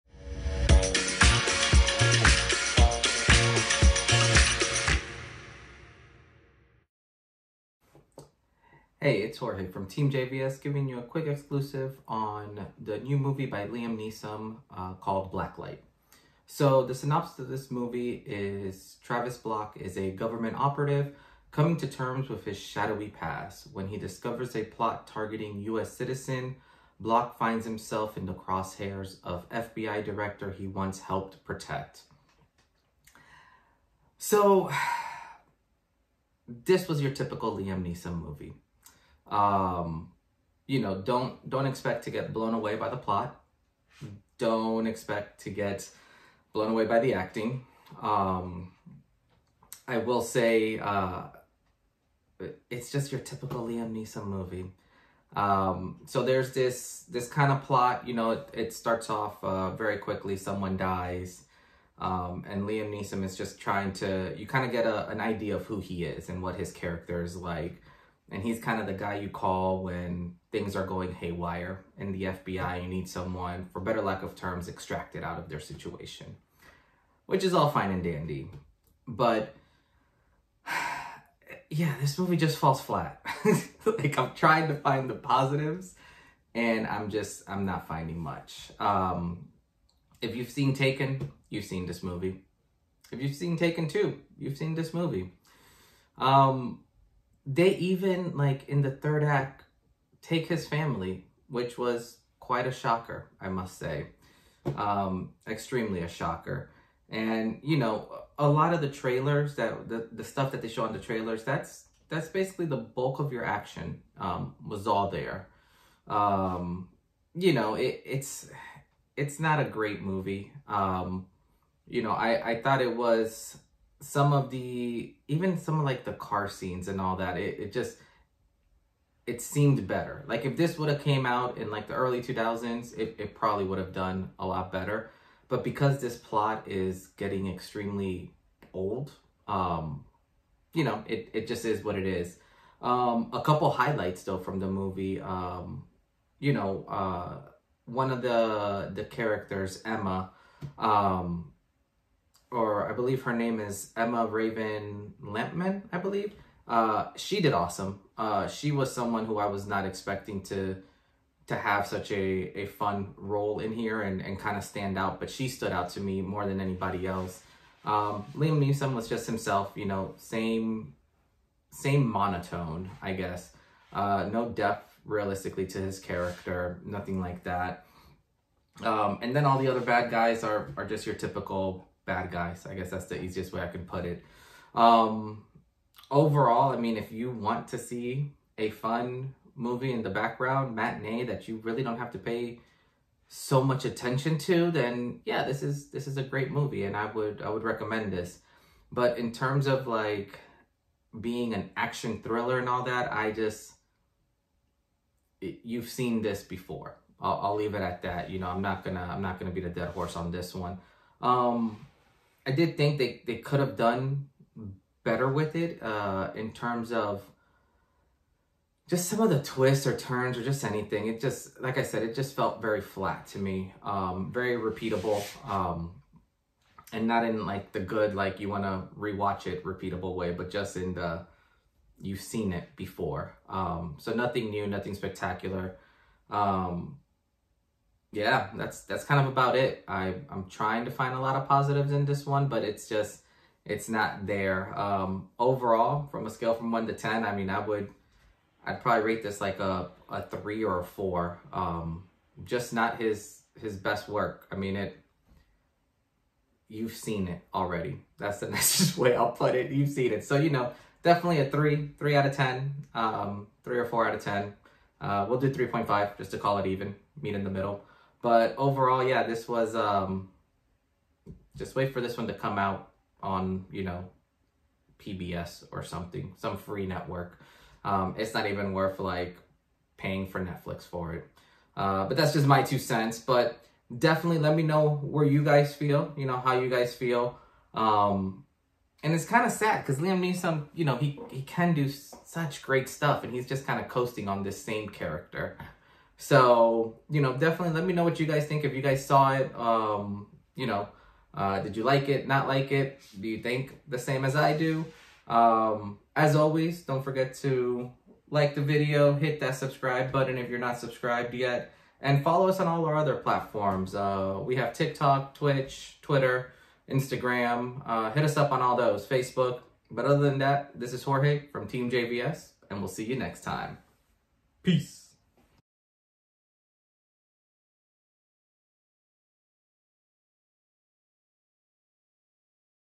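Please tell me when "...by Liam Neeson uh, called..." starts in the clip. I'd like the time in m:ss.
0:13.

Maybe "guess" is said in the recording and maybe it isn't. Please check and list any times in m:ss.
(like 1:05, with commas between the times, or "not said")
2:53, 3:02.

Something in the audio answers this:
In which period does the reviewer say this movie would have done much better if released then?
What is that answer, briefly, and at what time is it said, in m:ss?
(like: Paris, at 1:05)
Early 2000s, at 2:11.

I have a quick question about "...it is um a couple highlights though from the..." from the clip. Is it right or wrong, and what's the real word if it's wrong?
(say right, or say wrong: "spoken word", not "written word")
right.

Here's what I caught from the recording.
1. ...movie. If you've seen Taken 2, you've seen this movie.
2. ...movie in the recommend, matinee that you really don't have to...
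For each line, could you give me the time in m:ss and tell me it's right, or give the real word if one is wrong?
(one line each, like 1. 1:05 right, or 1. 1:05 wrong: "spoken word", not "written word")
1. 1:32 right
2. 3:09 wrong: "background", not "recommend".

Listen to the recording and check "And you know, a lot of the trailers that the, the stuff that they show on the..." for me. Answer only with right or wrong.
right.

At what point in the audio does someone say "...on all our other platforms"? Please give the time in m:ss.
5:12.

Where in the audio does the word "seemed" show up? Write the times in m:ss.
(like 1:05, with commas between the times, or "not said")
2:09.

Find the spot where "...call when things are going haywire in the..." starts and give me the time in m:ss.
1:09.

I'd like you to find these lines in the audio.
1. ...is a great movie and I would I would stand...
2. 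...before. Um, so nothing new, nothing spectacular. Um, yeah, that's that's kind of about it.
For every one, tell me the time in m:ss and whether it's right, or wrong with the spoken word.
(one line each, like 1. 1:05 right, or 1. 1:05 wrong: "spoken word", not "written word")
1. 3:16 wrong: "recommend", not "stand"
2. 3:52 right.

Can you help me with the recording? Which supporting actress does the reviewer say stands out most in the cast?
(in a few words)
Emma Raven Lampman.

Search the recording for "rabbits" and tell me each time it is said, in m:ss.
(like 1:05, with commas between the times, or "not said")
not said.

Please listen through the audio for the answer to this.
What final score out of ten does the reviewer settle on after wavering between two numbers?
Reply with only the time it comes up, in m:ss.
4:25.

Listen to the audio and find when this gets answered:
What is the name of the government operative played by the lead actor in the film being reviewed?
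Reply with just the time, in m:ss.
0:19.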